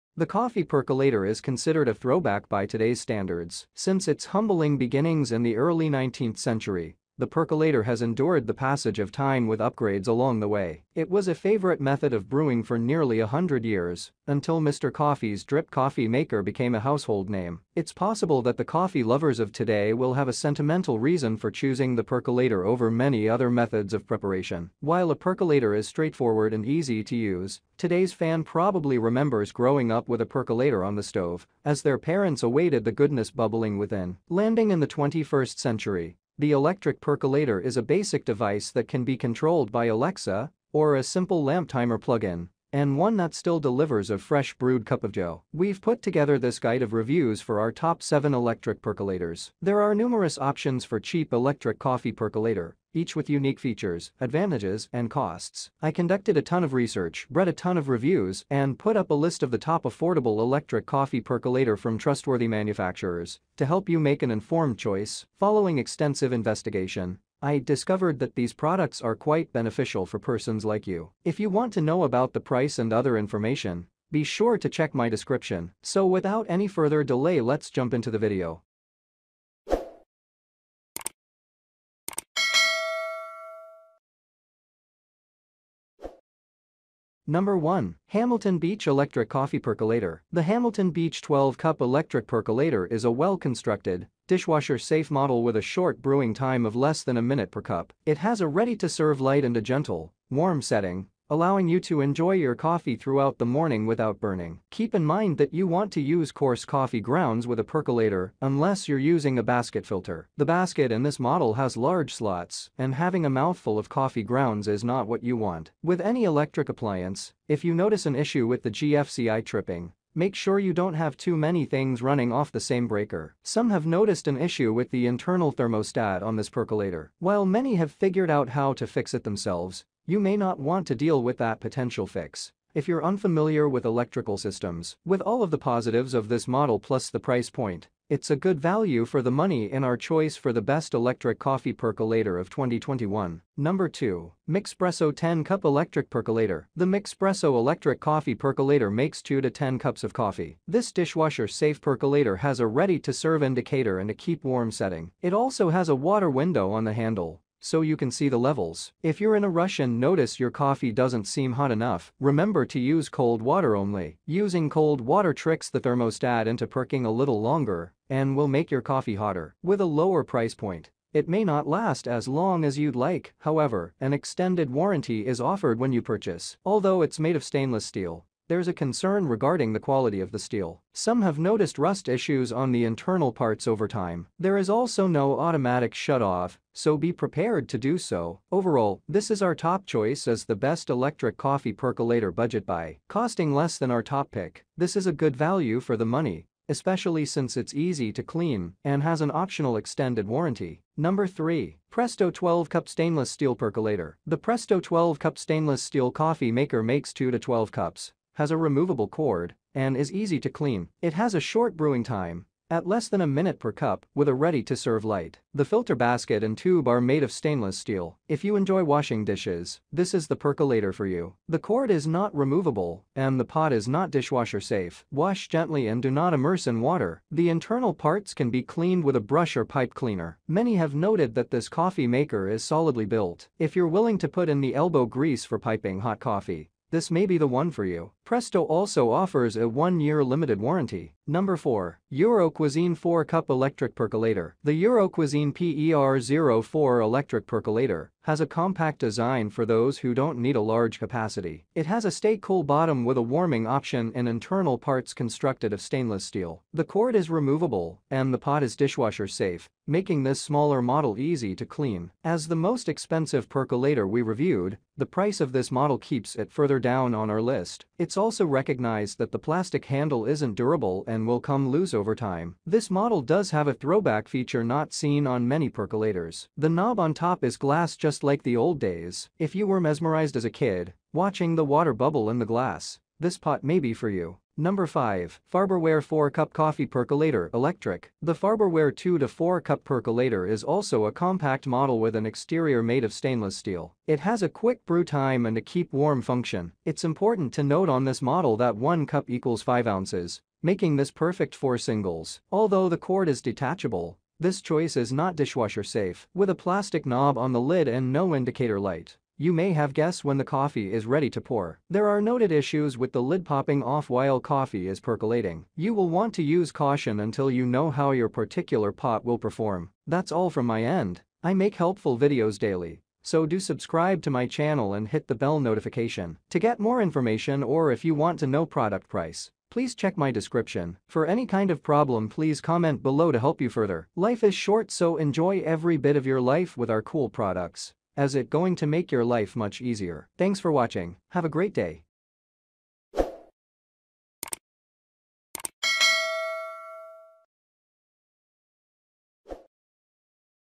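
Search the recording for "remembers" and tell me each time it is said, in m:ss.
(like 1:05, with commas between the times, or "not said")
0:28, 2:42.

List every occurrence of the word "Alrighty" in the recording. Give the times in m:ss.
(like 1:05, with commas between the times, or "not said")
not said.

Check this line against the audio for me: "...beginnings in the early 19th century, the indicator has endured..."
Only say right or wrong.
wrong.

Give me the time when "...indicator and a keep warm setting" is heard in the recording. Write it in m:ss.
2:33.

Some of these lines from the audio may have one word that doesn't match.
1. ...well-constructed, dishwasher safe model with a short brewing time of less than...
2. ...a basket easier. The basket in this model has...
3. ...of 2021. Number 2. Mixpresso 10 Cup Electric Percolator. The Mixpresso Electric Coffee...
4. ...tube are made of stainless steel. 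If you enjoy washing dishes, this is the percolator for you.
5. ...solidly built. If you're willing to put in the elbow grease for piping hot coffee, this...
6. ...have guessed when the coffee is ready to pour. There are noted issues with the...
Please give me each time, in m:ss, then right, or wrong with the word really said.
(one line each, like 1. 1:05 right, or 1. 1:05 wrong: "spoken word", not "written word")
1. 1:33 right
2. 1:49 wrong: "filter", not "easier"
3. 2:22 right
4. 3:36 right
5. 3:52 right
6. 5:09 right.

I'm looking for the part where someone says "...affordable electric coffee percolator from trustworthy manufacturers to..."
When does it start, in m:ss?
0:59.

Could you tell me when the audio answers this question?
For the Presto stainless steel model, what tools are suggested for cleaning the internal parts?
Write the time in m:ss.
3:49.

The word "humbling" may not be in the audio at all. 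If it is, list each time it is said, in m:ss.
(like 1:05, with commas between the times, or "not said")
0:04.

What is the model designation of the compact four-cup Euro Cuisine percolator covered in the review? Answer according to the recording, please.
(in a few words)
PER04.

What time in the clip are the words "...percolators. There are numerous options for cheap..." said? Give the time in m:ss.
0:48.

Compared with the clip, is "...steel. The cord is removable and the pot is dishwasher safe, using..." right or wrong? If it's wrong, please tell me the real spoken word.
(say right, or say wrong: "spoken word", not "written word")
wrong: "making", not "using".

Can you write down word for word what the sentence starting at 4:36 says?
The knob on top is glass just like the old days.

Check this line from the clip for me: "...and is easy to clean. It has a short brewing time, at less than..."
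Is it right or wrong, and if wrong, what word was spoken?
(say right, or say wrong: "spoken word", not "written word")
right.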